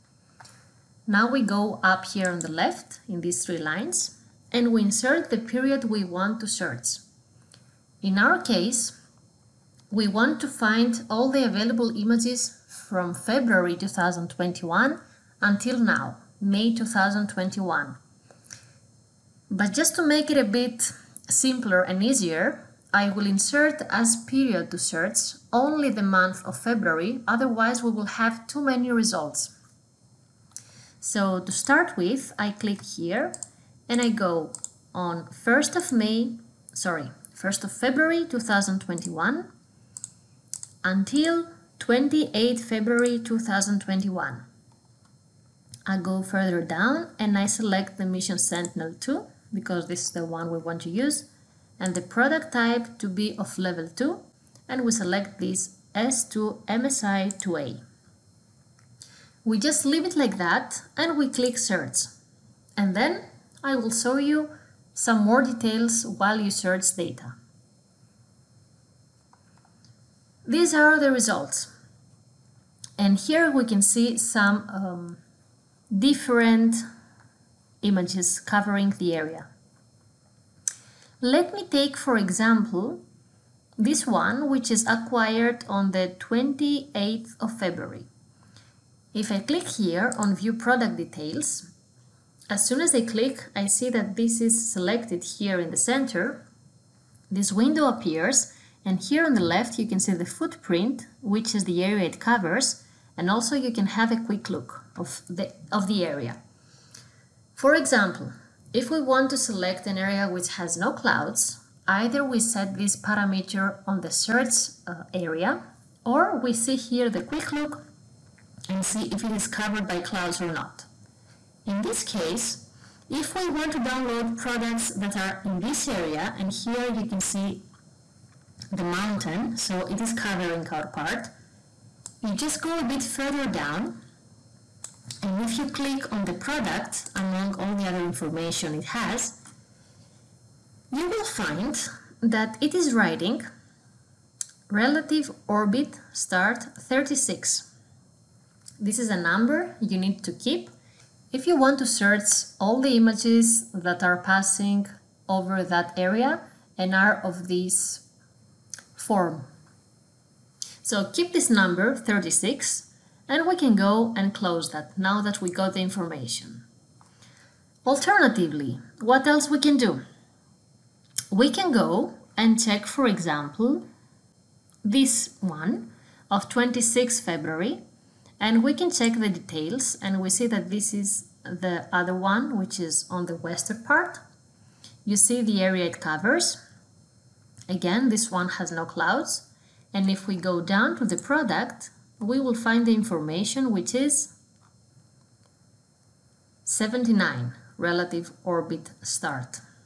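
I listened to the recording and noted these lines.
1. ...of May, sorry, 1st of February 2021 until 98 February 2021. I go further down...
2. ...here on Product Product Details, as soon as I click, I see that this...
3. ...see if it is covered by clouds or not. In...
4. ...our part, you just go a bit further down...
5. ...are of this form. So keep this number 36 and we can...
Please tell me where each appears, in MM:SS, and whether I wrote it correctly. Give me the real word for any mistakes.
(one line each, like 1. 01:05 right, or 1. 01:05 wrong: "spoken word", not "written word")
1. 00:35 wrong: "28", not "98"
2. 01:29 wrong: "View", not "Product"
3. 01:58 right
4. 02:10 right
5. 02:36 right.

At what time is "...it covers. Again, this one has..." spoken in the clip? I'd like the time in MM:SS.
03:05.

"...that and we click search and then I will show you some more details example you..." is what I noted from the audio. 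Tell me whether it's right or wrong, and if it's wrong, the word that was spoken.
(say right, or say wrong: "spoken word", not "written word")
wrong: "while", not "example".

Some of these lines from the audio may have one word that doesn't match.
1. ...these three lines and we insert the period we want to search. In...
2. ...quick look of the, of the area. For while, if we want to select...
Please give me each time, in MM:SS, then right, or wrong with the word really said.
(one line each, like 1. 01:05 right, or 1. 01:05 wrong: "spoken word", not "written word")
1. 00:03 right
2. 01:44 wrong: "example", not "while".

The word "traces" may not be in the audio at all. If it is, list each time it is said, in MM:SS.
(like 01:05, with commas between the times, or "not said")
not said.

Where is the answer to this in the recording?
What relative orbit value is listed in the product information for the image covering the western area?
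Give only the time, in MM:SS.
03:16.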